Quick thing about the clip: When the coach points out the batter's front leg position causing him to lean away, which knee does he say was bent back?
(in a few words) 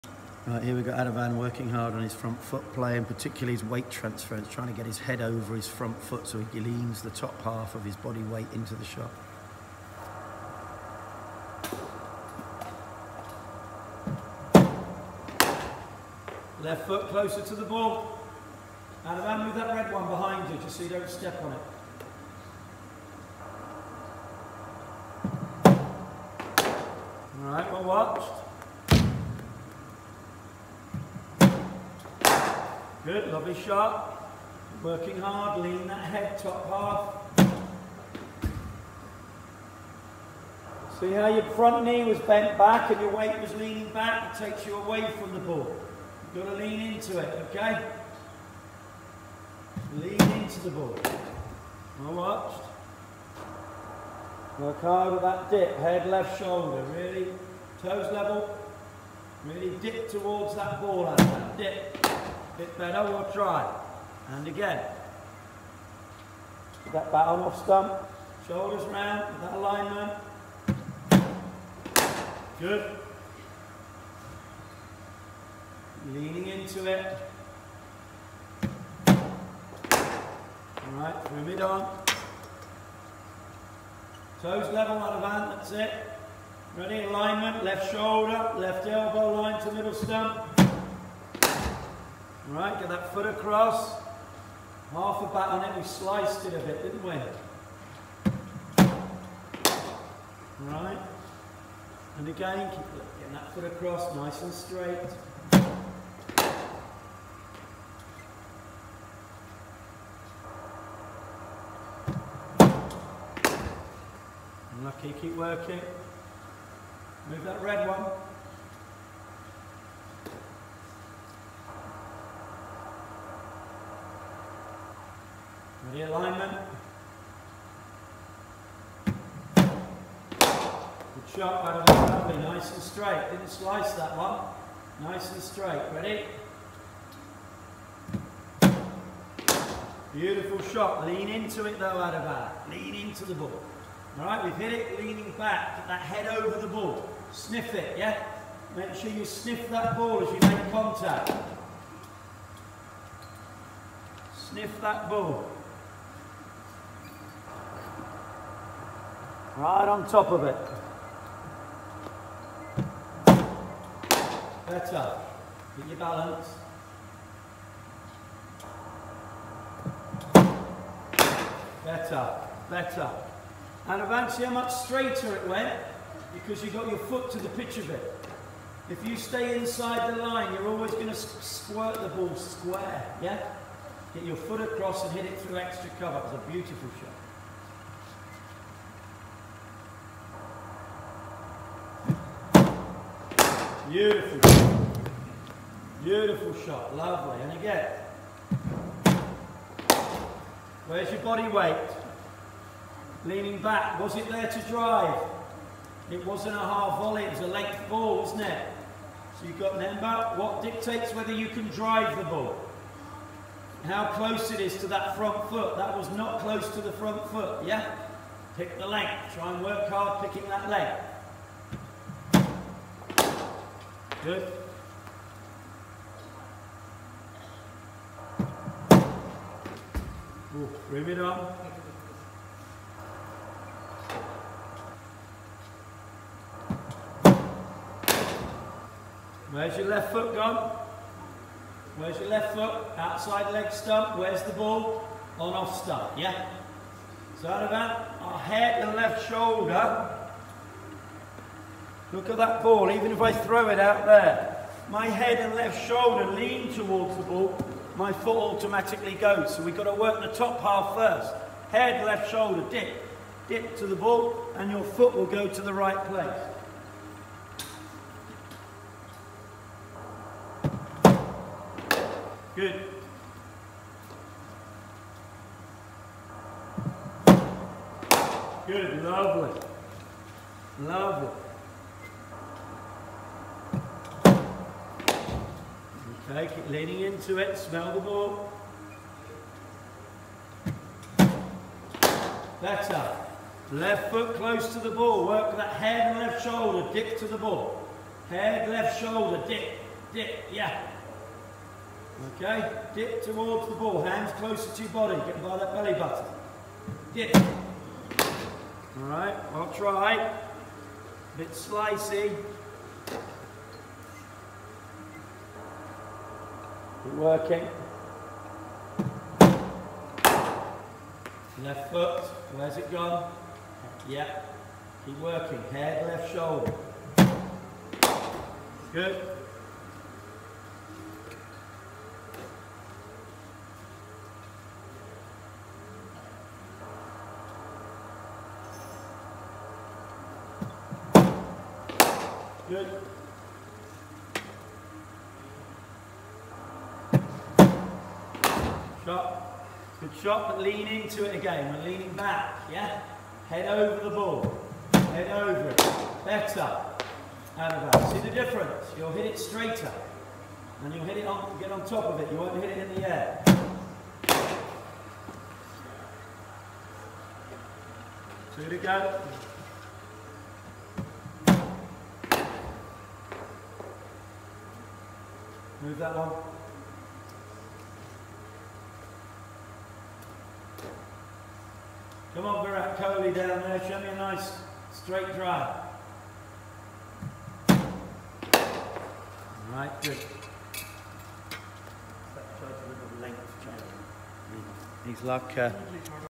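front knee.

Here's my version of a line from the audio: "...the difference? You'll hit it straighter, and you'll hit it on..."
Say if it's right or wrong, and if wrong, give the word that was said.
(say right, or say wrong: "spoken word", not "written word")
right.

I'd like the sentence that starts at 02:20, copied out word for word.
Beautiful shot, lean into it though Adabar, lean into the ball.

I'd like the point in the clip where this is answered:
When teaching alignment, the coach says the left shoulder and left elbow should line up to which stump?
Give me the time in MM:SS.
01:29.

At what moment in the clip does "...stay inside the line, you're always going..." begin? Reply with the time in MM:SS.
02:59.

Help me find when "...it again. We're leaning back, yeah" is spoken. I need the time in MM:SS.
05:51.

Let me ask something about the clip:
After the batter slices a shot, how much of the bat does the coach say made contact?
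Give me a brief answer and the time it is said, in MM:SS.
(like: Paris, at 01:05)
Half a bat, at 01:34.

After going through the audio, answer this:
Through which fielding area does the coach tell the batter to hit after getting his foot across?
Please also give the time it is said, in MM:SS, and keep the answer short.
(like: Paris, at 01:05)
extra cover, at 03:05.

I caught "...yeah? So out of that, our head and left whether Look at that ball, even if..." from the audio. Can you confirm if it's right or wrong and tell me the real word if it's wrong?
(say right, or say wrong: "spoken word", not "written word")
wrong: "shoulder", not "whether".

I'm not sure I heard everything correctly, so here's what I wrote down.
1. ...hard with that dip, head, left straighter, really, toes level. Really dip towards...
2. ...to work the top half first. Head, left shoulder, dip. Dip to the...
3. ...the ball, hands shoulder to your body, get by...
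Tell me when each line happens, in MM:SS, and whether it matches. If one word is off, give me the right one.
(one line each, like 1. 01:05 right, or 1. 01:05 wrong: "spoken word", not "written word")
1. 00:54 wrong: "shoulder", not "straighter"
2. 04:19 right
3. 05:03 wrong: "closer", not "shoulder".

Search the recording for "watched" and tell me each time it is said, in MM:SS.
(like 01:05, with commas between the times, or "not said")
00:27, 00:52.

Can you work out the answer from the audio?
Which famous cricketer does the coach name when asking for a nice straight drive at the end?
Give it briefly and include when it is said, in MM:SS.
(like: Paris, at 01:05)
Virat Kohli, at 06:22.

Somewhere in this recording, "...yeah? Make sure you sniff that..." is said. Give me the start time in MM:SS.
02:27.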